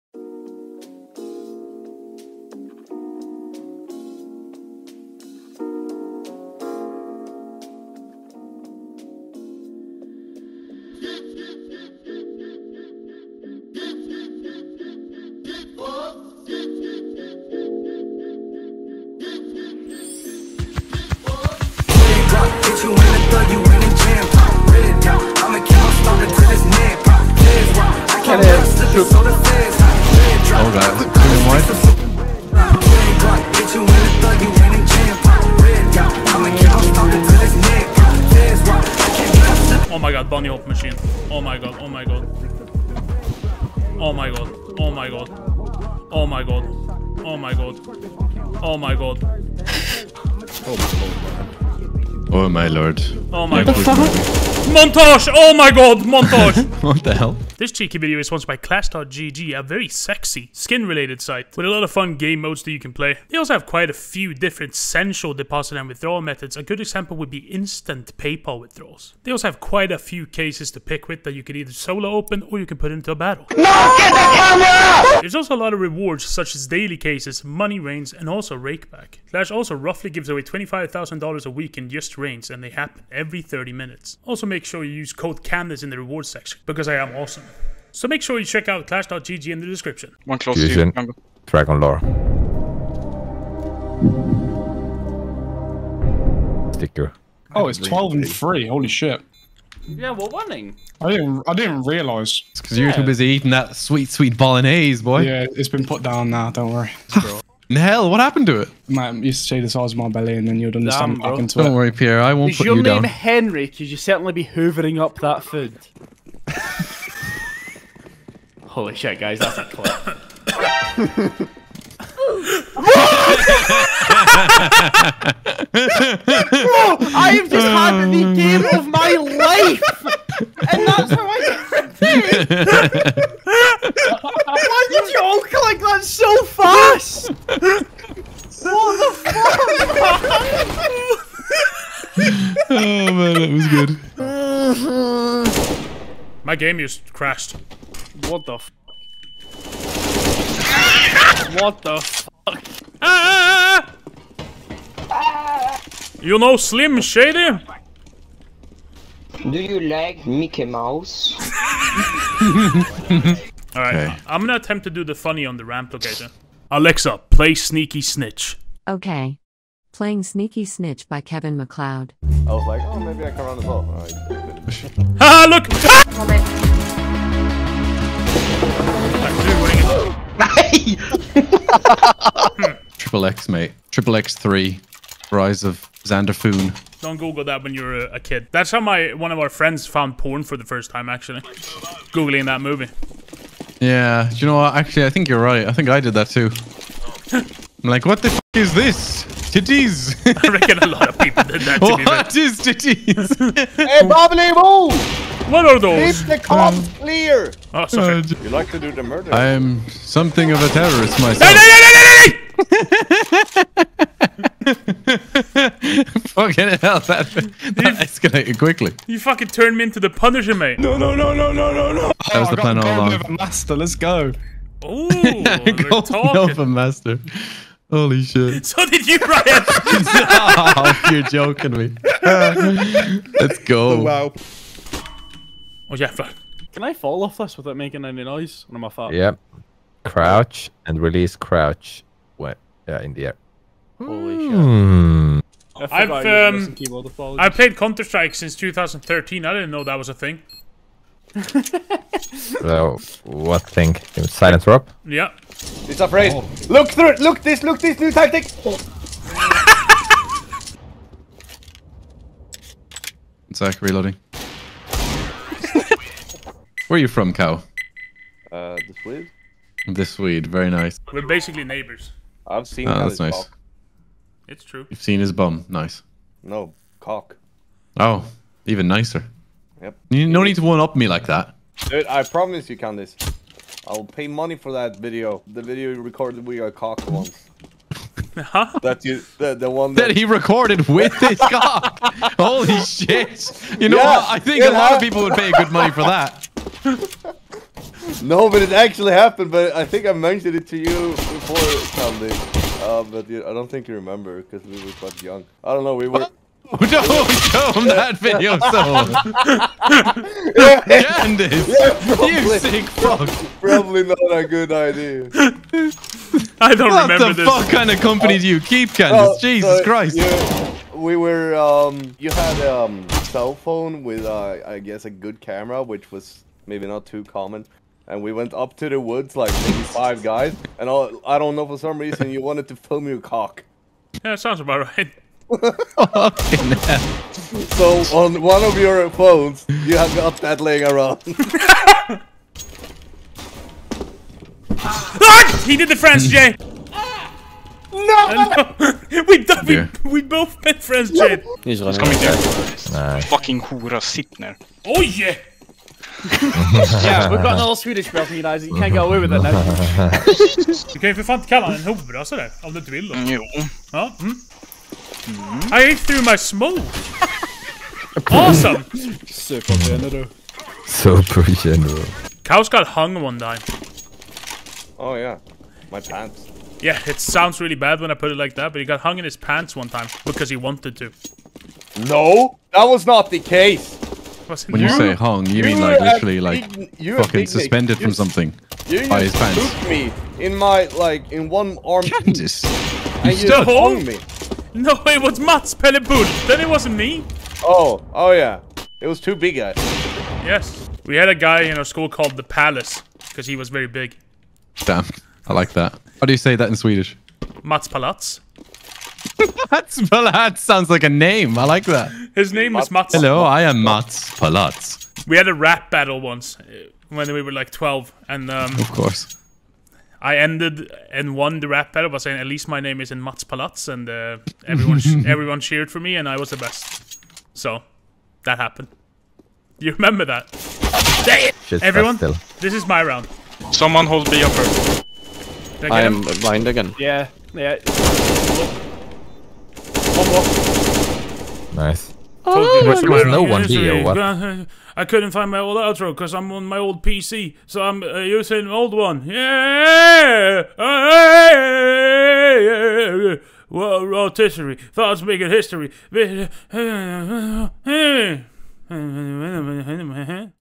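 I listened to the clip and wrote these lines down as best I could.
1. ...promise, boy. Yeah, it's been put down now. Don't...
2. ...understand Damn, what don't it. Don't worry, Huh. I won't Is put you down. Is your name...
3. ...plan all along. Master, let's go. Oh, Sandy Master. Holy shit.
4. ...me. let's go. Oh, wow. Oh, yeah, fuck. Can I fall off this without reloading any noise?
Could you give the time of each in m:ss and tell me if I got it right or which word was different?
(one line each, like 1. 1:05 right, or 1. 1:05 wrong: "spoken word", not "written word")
1. 1:44 wrong: "bolognese", not "promise"
2. 1:50 wrong: "Pierre", not "Huh"
3. 3:42 wrong: "Nova", not "Sandy"
4. 3:51 wrong: "making", not "reloading".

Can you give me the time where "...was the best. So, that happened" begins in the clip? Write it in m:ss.
7:06.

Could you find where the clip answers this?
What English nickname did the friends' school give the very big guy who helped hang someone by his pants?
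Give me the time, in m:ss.
6:42.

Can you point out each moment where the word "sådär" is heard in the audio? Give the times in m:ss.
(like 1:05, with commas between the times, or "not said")
6:02.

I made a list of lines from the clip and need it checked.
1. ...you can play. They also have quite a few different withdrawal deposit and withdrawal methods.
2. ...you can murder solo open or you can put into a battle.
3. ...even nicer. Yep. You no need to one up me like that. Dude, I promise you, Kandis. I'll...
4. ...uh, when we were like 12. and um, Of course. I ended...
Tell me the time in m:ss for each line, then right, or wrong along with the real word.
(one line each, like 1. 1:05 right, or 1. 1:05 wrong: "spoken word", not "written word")
1. 1:02 wrong: "sensual", not "withdrawal"
2. 1:11 wrong: "either", not "murder"
3. 4:38 right
4. 6:56 right.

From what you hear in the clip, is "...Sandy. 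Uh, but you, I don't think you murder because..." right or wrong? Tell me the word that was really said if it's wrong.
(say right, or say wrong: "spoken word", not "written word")
wrong: "remember", not "murder".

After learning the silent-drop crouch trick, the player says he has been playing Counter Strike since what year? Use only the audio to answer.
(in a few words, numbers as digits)
2013.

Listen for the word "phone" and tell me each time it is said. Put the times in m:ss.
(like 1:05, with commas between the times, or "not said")
5:23, 5:39.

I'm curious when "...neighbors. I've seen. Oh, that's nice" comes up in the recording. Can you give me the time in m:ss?
4:31.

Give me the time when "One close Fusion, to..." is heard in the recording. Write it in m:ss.
1:30.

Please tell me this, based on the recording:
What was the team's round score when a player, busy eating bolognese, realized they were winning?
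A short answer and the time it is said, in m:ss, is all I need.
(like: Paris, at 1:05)
12 and 3, at 1:37.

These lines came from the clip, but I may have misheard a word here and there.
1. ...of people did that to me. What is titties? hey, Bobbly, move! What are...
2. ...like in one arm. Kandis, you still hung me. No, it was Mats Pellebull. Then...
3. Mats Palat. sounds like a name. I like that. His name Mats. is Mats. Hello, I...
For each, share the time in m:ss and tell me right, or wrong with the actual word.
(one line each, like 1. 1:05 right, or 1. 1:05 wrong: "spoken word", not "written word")
1. 3:21 right
2. 6:30 right
3. 6:49 right.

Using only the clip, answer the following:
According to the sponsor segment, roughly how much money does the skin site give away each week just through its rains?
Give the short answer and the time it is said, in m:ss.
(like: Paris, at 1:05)
$25,000, at 1:20.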